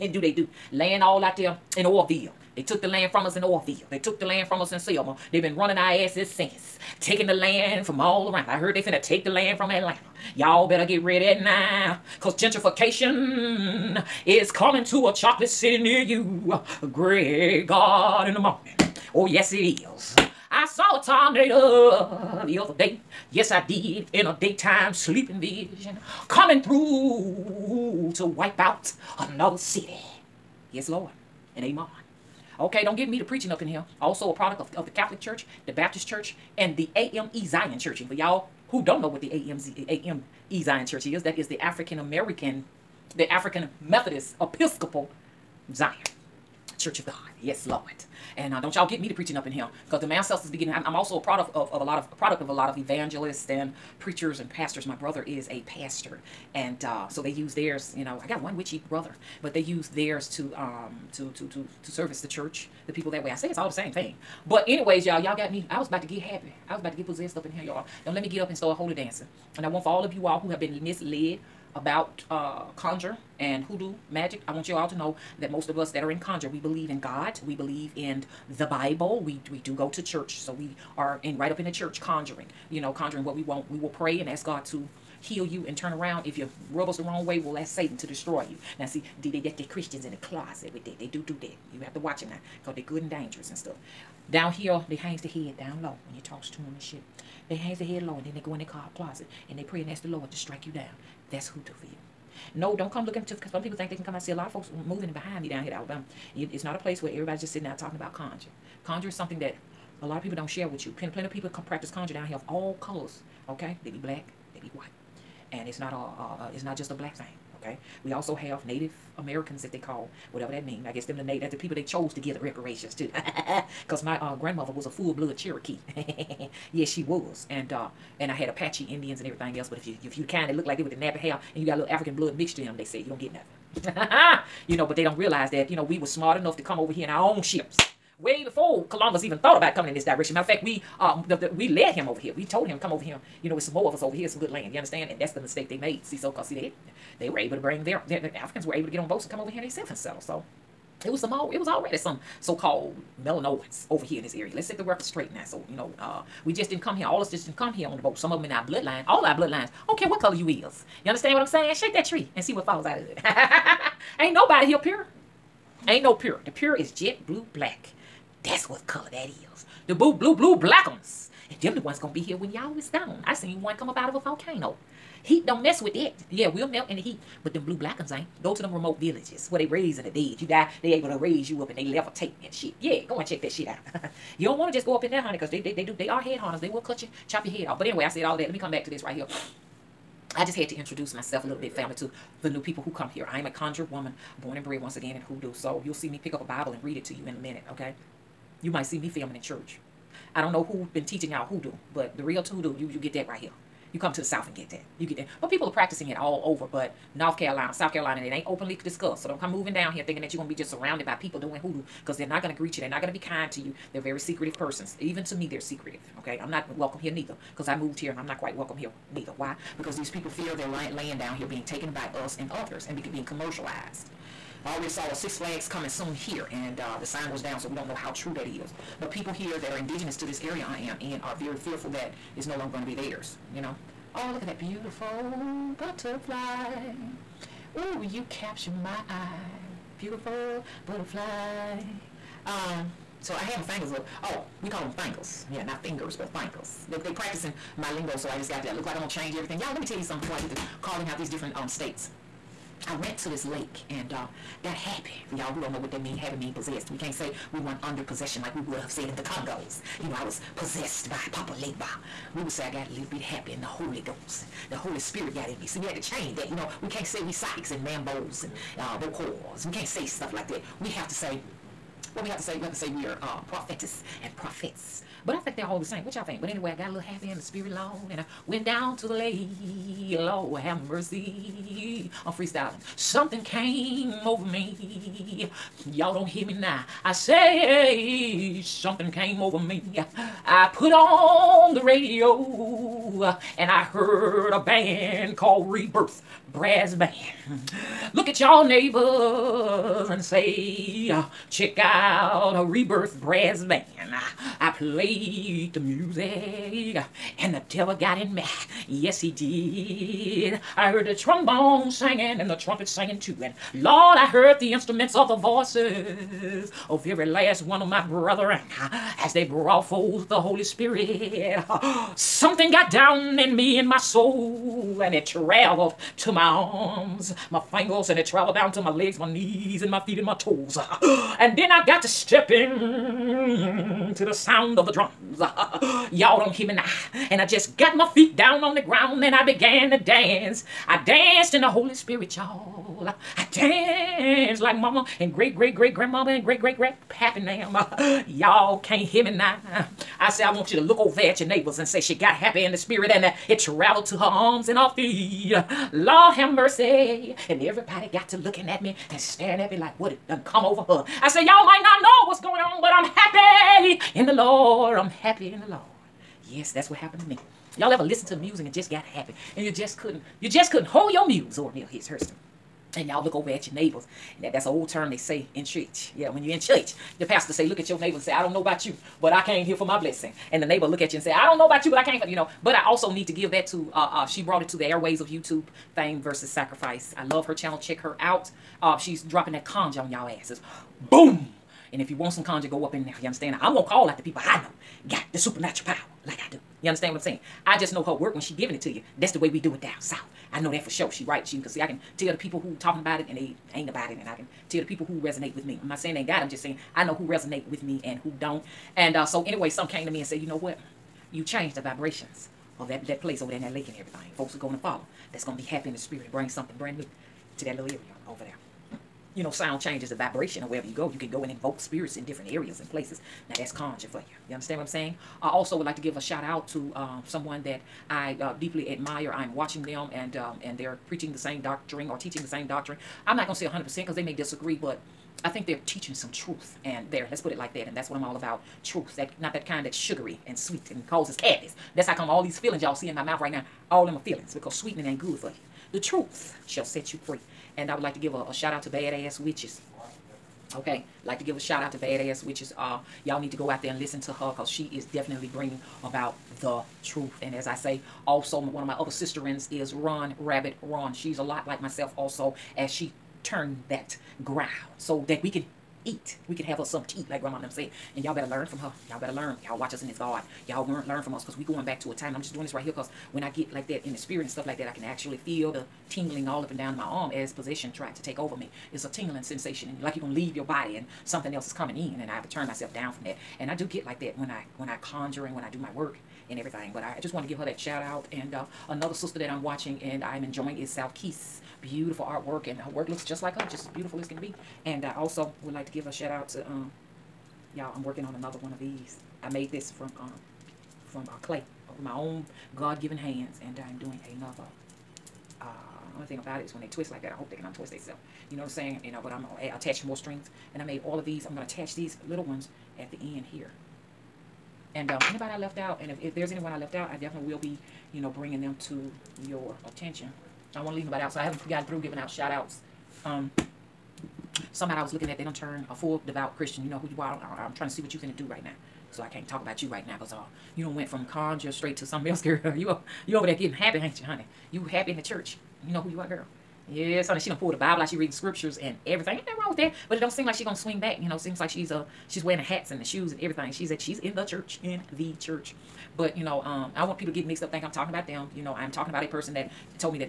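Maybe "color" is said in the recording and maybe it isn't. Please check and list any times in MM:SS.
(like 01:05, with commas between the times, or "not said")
01:52, 02:40, 02:48.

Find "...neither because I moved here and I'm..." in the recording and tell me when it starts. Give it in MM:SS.
03:37.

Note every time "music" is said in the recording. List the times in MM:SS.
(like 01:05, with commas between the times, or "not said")
05:05, 06:08.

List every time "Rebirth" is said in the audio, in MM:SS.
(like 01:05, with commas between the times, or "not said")
04:55, 05:02.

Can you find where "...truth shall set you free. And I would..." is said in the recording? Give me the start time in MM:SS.
07:25.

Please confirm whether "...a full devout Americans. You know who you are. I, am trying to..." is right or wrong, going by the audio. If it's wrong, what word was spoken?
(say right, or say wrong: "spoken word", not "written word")
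wrong: "Christian", not "Americans".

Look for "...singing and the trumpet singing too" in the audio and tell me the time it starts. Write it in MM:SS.
05:11.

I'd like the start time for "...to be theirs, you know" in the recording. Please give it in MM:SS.
03:52.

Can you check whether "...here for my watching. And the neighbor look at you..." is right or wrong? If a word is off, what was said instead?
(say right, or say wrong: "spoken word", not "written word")
wrong: "blessing", not "watching".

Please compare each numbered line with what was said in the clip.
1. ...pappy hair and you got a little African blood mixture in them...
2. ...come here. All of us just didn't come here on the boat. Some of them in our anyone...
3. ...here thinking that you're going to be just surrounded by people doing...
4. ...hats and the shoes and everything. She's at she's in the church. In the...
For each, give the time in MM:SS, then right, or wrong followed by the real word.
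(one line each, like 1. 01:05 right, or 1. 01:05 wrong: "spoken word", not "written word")
1. 02:10 wrong: "nappy", not "pappy"
2. 02:36 wrong: "bloodline", not "anyone"
3. 03:29 right
4. 09:02 right.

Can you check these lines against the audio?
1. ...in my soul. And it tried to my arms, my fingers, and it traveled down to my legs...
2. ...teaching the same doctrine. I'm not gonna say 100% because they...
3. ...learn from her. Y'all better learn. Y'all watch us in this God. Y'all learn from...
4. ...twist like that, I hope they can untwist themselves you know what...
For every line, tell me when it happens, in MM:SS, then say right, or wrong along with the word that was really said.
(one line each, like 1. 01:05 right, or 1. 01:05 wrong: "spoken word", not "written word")
1. 05:23 wrong: "traveled", not "tried"
2. 07:12 right
3. 07:48 right
4. 08:26 right.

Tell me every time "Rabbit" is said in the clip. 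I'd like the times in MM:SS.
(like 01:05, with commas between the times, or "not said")
07:40.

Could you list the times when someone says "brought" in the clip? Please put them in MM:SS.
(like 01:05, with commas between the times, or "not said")
05:19, 06:24.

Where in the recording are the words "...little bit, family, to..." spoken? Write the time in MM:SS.
03:11.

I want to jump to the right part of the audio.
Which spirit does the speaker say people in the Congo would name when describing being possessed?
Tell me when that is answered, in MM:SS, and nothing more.
04:21.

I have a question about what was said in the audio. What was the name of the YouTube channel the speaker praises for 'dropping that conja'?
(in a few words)
Fame versus Sacrifice.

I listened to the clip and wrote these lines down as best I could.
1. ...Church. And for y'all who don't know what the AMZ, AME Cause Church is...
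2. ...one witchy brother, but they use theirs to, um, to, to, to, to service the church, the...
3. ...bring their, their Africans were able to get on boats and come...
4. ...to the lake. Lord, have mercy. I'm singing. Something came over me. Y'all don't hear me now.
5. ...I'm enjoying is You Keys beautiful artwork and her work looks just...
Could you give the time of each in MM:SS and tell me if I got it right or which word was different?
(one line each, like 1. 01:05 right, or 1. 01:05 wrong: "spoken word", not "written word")
1. 00:37 wrong: "Zion", not "Cause"
2. 00:58 right
3. 02:27 right
4. 04:39 wrong: "freestyling", not "singing"
5. 08:10 wrong: "South", not "You".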